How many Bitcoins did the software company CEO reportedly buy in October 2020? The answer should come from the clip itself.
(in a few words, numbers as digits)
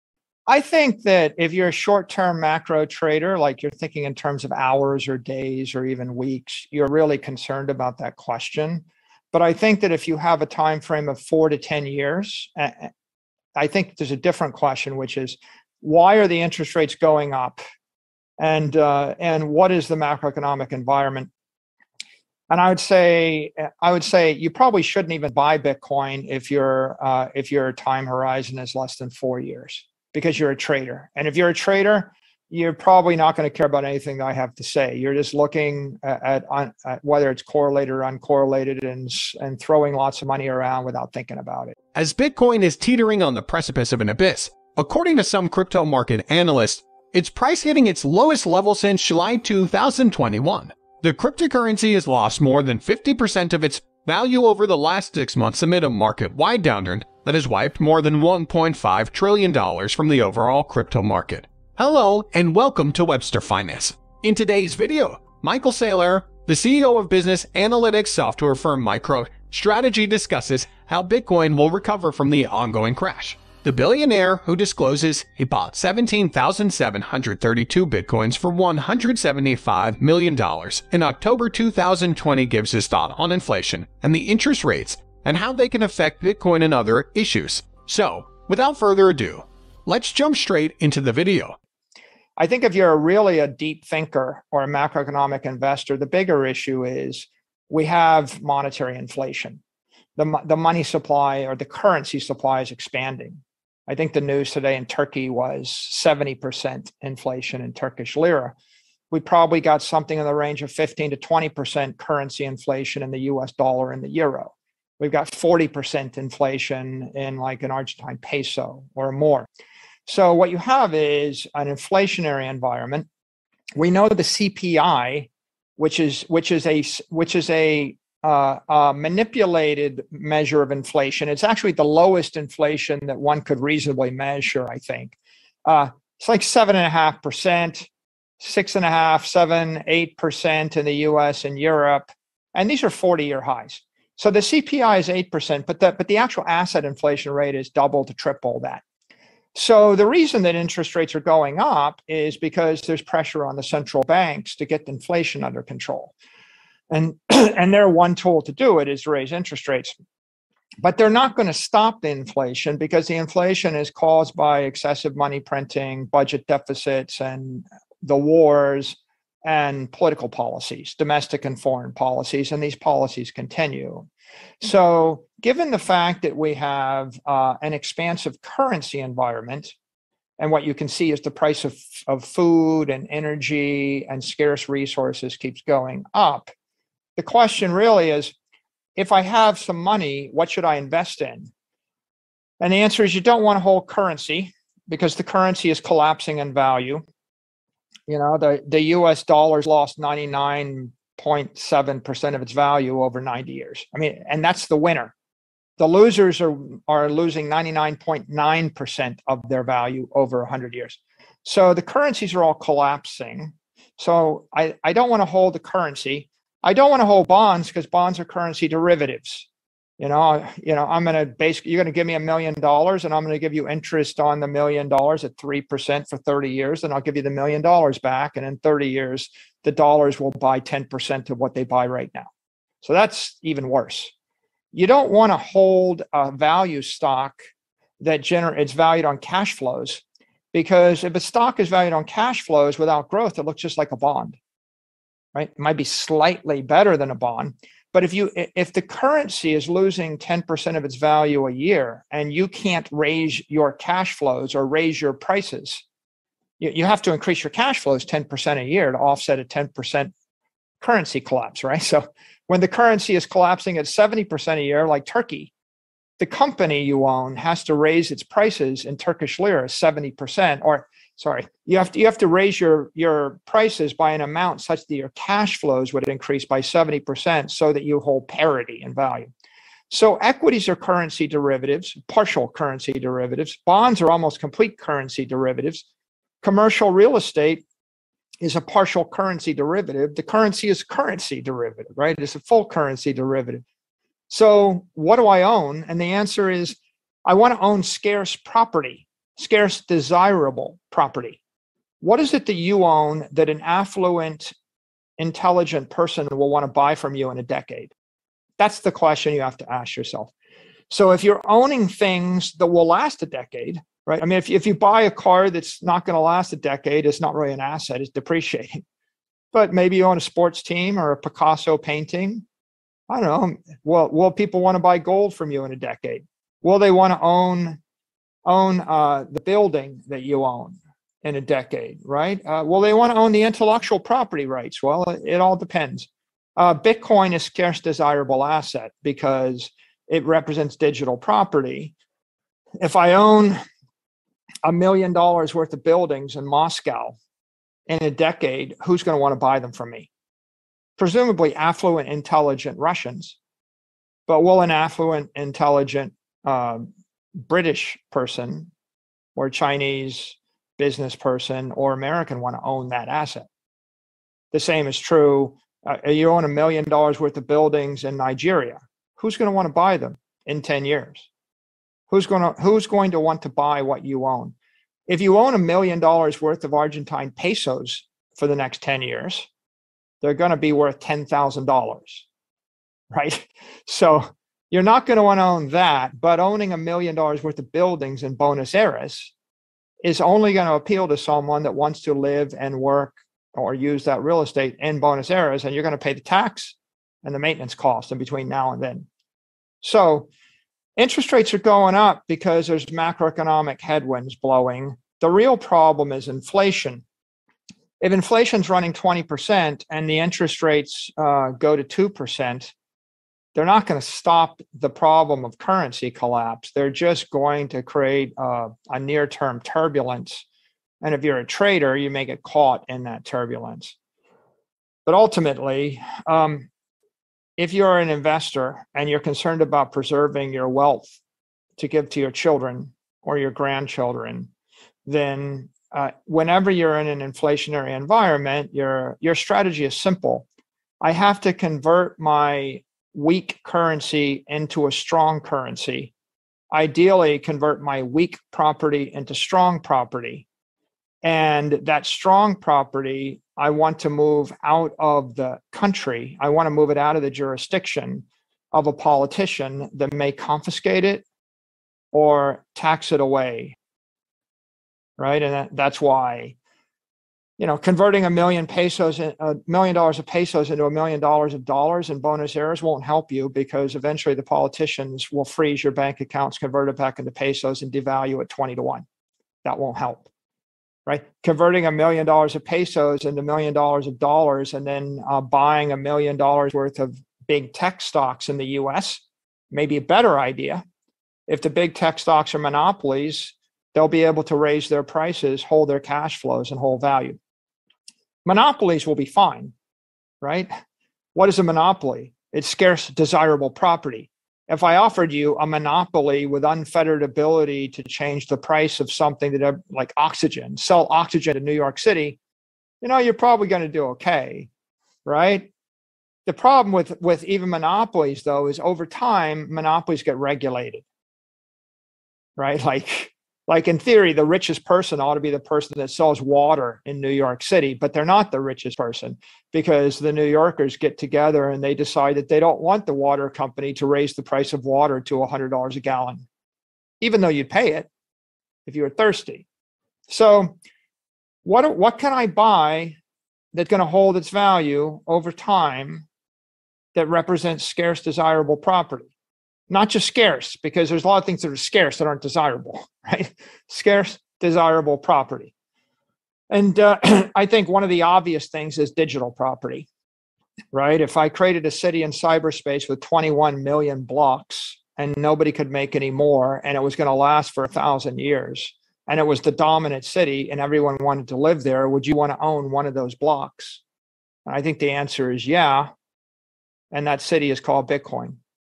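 17,732.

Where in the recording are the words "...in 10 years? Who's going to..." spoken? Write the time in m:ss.
6:10.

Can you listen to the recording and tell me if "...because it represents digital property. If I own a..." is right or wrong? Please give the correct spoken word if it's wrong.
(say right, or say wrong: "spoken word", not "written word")
right.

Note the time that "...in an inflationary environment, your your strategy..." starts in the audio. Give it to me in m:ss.
7:16.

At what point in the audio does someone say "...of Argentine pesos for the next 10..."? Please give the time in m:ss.
6:16.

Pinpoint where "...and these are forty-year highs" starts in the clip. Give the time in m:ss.
2:22.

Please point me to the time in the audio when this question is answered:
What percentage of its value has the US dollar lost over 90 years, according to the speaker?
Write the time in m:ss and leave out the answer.
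3:19.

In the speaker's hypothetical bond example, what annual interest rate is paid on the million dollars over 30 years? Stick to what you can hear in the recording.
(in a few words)
3%.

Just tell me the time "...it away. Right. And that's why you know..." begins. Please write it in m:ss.
7:43.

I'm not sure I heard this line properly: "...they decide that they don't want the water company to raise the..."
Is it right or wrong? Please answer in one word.
right.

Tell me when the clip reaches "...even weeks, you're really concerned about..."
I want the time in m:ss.
0:05.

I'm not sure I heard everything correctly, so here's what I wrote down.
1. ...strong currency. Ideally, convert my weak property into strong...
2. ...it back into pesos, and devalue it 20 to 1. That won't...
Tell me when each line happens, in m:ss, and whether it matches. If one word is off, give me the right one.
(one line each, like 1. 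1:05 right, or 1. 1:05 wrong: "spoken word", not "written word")
1. 7:24 right
2. 7:56 right.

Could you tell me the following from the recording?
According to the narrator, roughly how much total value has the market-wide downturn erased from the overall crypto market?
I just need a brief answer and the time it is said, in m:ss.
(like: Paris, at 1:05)
$1.5 trillion, at 0:58.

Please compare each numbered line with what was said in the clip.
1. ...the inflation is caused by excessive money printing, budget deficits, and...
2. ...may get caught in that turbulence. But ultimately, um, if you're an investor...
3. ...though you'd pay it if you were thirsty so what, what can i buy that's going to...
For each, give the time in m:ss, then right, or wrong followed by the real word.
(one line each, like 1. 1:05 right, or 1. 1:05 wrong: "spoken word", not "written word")
1. 2:43 right
2. 7:02 right
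3. 8:57 right.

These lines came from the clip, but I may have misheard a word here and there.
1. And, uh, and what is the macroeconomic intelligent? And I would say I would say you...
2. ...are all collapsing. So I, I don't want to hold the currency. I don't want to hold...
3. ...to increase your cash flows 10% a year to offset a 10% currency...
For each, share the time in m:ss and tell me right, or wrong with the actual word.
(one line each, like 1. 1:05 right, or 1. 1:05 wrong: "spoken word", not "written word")
1. 0:18 wrong: "environment", not "intelligent"
2. 3:32 right
3. 4:17 right.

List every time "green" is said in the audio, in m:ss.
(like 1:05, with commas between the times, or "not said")
not said.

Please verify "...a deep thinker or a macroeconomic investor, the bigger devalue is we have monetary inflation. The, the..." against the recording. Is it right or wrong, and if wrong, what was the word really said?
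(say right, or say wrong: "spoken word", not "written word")
wrong: "issue", not "devalue".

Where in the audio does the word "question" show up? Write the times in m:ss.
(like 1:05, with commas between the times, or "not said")
0:08, 0:14, 3:07, 5:08.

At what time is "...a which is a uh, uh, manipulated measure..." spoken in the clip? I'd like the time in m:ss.
2:06.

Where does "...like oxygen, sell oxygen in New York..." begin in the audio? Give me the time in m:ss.
8:29.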